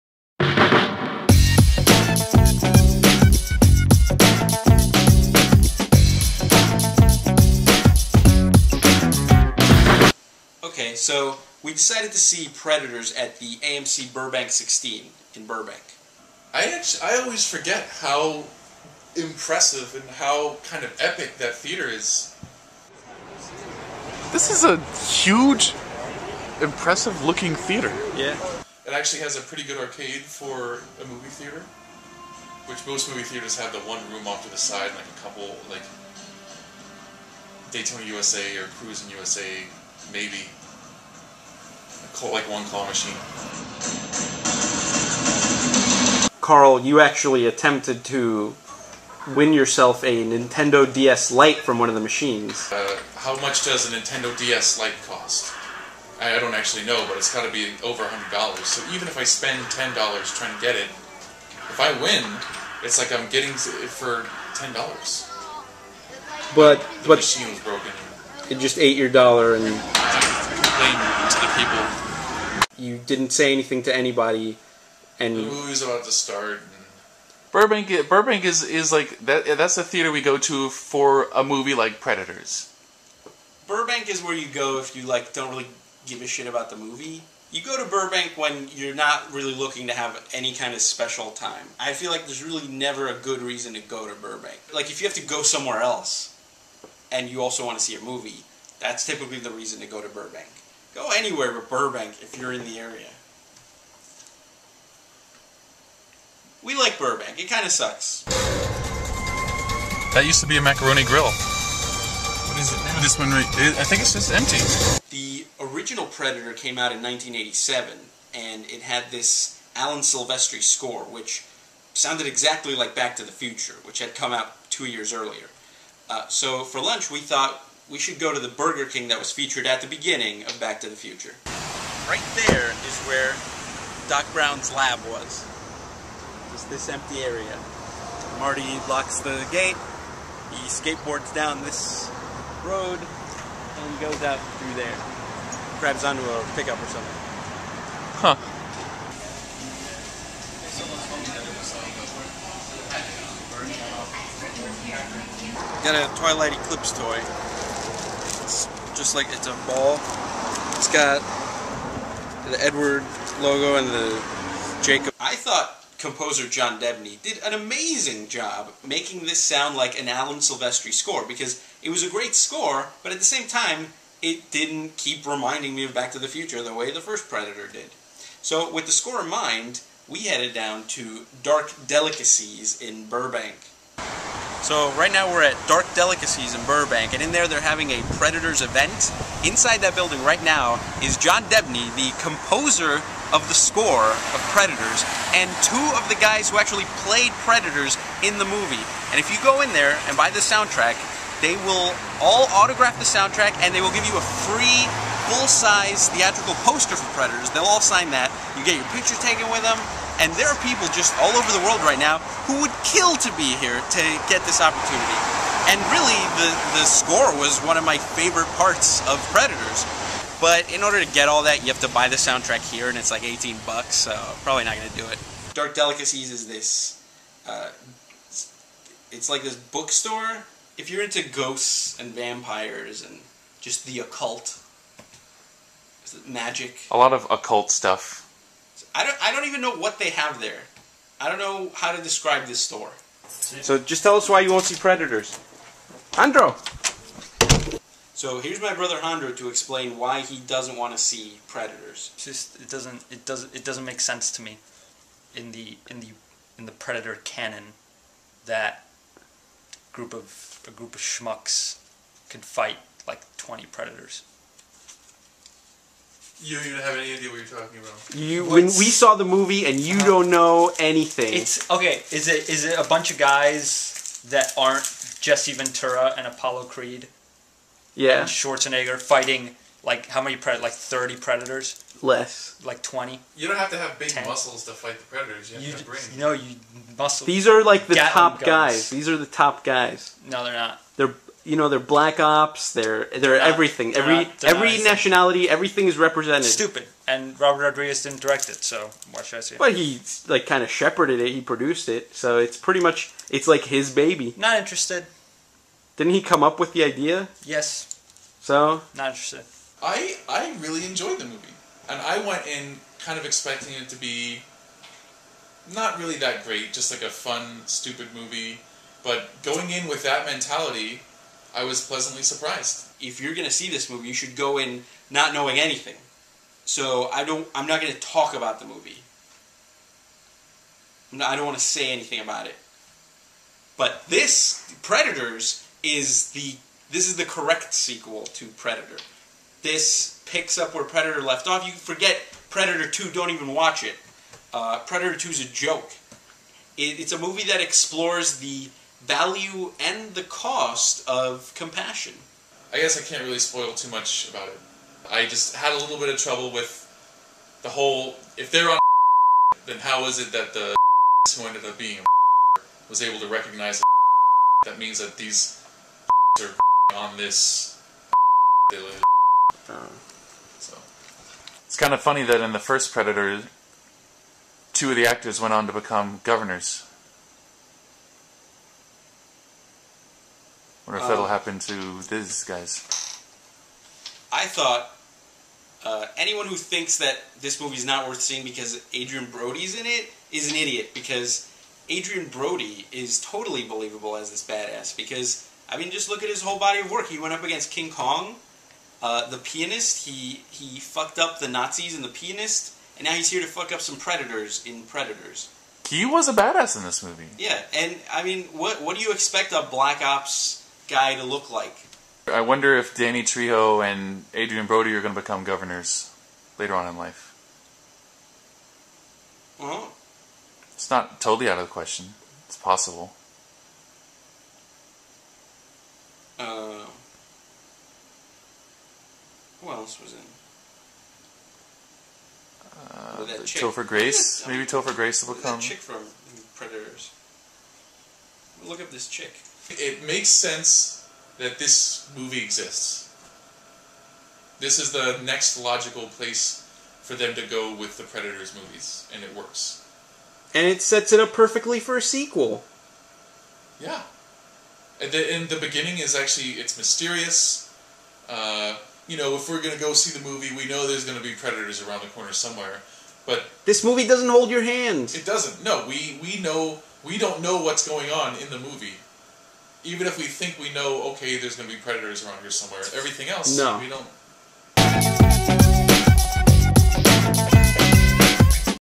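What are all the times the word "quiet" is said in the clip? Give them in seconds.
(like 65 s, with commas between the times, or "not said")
not said.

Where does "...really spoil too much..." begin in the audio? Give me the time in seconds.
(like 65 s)
353 s.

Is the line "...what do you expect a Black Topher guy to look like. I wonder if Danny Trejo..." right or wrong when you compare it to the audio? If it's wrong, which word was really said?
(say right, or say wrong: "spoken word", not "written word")
wrong: "Ops", not "Topher".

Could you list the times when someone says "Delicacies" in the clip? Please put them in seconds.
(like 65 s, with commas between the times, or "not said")
181 s, 185 s, 225 s.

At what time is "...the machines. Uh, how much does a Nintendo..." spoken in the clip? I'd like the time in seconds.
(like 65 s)
51 s.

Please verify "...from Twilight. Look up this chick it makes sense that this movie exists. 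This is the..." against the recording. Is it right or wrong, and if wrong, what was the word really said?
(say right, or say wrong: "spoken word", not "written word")
wrong: "Predators", not "Twilight".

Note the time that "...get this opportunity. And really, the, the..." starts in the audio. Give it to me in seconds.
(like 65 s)
214 s.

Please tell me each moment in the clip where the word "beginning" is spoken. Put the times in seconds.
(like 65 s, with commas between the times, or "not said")
129 s, 455 s.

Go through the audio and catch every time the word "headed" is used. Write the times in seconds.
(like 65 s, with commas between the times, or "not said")
180 s.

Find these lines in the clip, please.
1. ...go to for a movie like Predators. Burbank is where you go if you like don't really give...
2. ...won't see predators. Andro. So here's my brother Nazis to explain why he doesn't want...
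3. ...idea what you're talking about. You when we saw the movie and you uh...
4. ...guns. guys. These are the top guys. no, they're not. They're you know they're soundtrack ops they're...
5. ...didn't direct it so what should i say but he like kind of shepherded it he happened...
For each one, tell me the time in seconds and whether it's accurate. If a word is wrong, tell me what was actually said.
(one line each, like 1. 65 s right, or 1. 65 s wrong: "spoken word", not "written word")
1. 80 s right
2. 244 s wrong: "Andro", not "Nazis"
3. 267 s right
4. 288 s wrong: "black", not "soundtrack"
5. 298 s wrong: "produced", not "happened".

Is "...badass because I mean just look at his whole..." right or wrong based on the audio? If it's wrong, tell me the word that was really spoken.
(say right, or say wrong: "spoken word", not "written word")
right.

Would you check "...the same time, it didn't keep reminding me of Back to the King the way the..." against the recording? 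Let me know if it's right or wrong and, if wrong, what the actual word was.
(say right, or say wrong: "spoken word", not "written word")
wrong: "Future", not "King".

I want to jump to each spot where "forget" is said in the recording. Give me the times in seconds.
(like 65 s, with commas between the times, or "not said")
17 s, 341 s.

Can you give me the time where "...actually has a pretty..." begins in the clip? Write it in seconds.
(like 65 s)
28 s.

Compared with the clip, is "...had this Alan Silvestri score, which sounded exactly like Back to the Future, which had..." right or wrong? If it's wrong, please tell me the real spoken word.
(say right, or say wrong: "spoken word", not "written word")
right.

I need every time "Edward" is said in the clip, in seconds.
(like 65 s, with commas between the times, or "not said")
162 s.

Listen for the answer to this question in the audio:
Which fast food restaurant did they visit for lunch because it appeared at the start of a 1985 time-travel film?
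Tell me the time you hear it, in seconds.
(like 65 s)
128 s.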